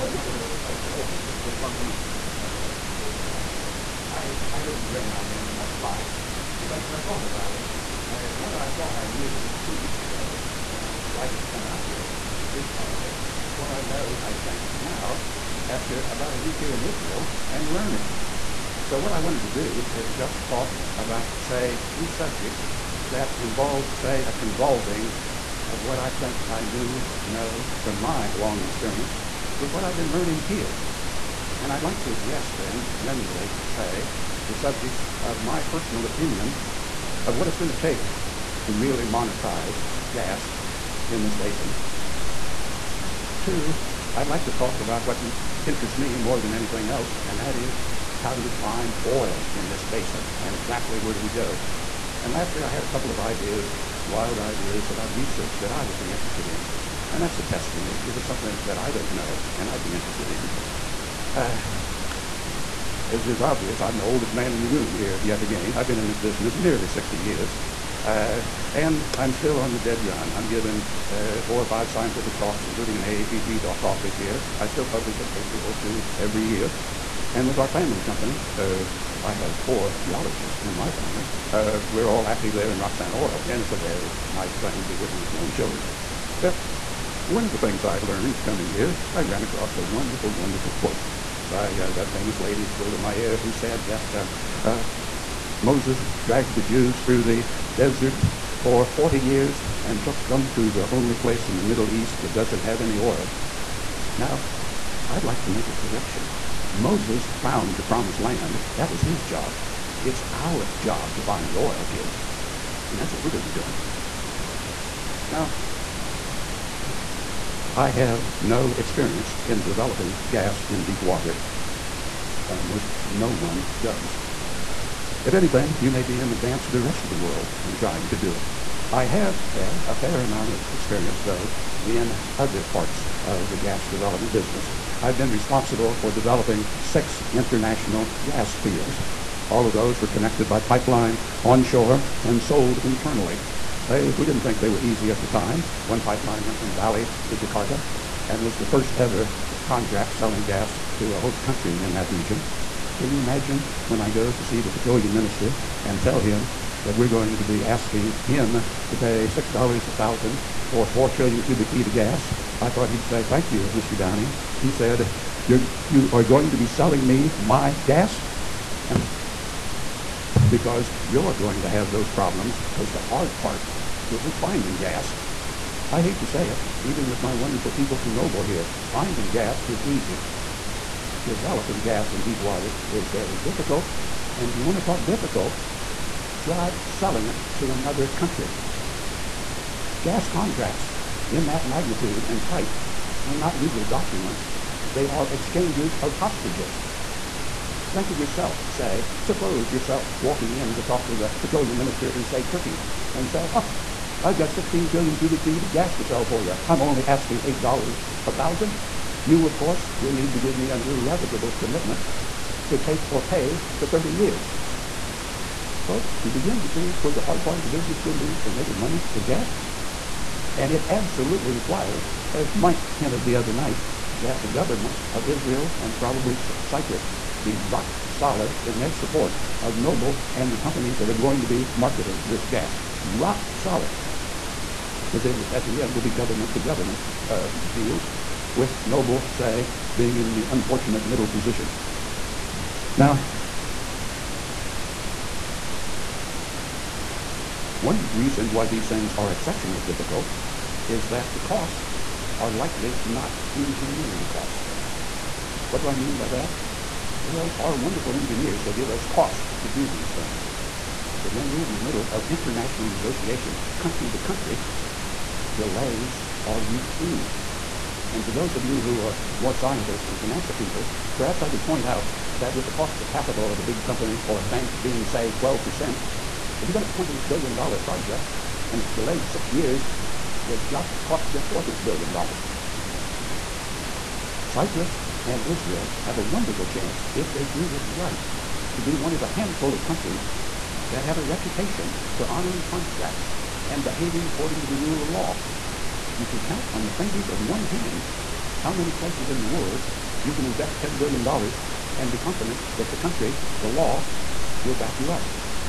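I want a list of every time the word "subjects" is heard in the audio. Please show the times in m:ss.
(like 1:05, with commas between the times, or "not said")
0:22, 0:34.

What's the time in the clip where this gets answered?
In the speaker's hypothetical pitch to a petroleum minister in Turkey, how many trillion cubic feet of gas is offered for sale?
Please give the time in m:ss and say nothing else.
3:24.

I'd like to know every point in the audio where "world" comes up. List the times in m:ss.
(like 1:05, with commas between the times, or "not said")
2:07, 4:59.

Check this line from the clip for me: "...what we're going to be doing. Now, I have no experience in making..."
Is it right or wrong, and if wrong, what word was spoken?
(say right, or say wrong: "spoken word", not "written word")
wrong: "developing", not "making".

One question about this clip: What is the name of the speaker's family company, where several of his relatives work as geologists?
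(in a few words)
Roxanna Oil.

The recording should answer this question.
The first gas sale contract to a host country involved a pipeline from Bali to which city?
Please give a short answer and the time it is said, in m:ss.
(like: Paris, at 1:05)
Jakarta, at 2:27.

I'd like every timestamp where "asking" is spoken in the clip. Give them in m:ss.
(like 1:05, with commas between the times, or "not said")
2:37, 3:27.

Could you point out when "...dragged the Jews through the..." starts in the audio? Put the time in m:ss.
1:36.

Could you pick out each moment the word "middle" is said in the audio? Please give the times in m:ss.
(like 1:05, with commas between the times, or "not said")
1:41, 4:01, 4:21.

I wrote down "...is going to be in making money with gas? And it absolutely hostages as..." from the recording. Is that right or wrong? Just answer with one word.
wrong.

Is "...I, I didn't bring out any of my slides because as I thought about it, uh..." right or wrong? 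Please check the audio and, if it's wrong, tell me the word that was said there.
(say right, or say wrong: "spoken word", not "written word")
right.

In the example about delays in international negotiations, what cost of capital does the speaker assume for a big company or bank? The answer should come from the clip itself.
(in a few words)
12%.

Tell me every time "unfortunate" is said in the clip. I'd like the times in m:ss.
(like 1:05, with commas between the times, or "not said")
4:00.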